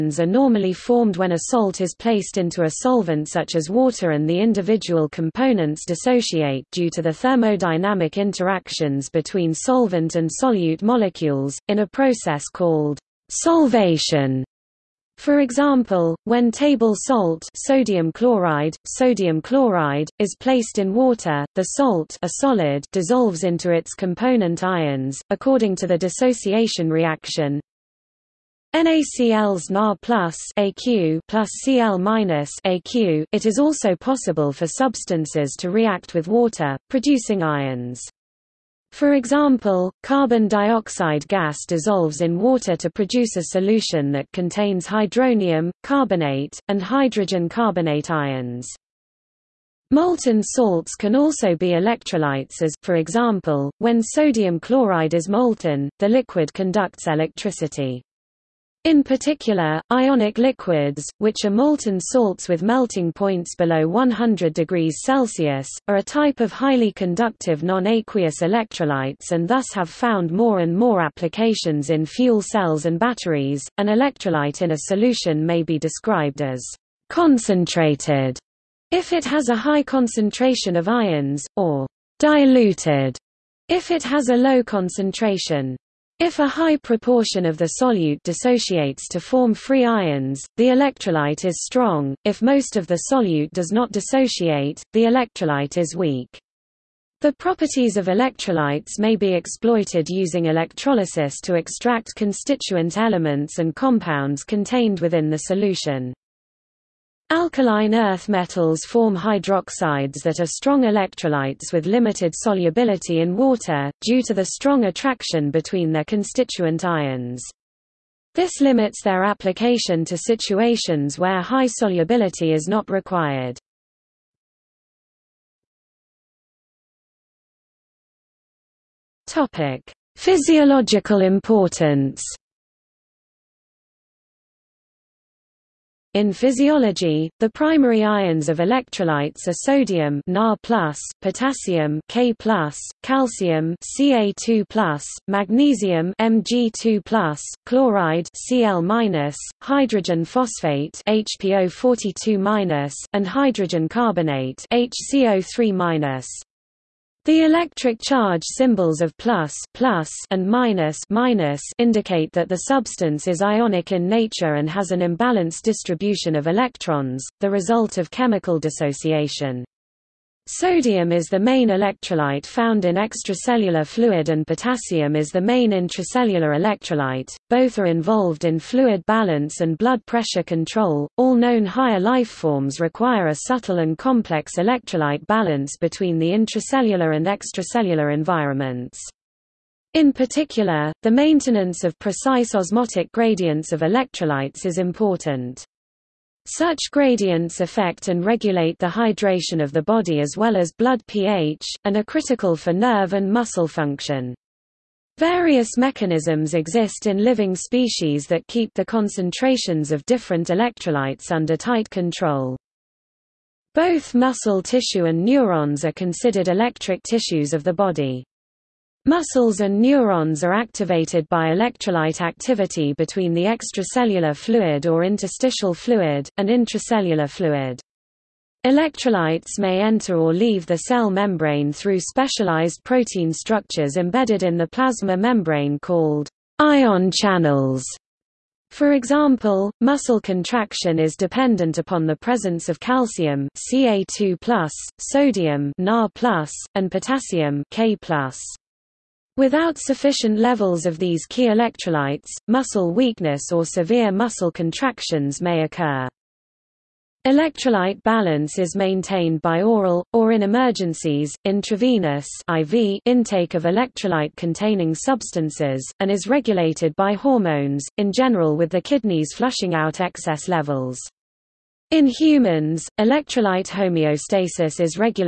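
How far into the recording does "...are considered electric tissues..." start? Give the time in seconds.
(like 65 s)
215 s.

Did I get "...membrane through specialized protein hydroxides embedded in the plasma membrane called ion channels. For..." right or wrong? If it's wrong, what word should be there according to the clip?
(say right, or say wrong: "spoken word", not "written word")
wrong: "structures", not "hydroxides".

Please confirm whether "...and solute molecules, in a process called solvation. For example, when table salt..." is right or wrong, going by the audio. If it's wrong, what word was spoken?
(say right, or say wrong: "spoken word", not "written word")
right.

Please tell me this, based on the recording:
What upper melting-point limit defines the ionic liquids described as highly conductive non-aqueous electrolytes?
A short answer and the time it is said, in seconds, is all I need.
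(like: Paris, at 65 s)
100 degrees Celsius, at 63 s.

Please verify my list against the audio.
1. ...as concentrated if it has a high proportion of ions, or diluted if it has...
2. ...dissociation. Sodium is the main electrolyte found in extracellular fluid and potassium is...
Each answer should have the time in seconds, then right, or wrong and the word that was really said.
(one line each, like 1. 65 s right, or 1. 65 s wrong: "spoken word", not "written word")
1. 76 s wrong: "concentration", not "proportion"
2. 168 s right.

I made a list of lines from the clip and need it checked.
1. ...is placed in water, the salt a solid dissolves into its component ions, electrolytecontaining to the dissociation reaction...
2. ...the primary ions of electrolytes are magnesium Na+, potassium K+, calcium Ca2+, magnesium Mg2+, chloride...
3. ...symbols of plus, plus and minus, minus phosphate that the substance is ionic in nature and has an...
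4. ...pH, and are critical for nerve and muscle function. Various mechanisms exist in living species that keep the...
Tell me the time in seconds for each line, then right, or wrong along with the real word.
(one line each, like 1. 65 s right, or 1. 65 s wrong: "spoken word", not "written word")
1. 20 s wrong: "according", not "electrolytecontaining"
2. 137 s wrong: "sodium", not "magnesium"
3. 158 s wrong: "indicate", not "phosphate"
4. 201 s right.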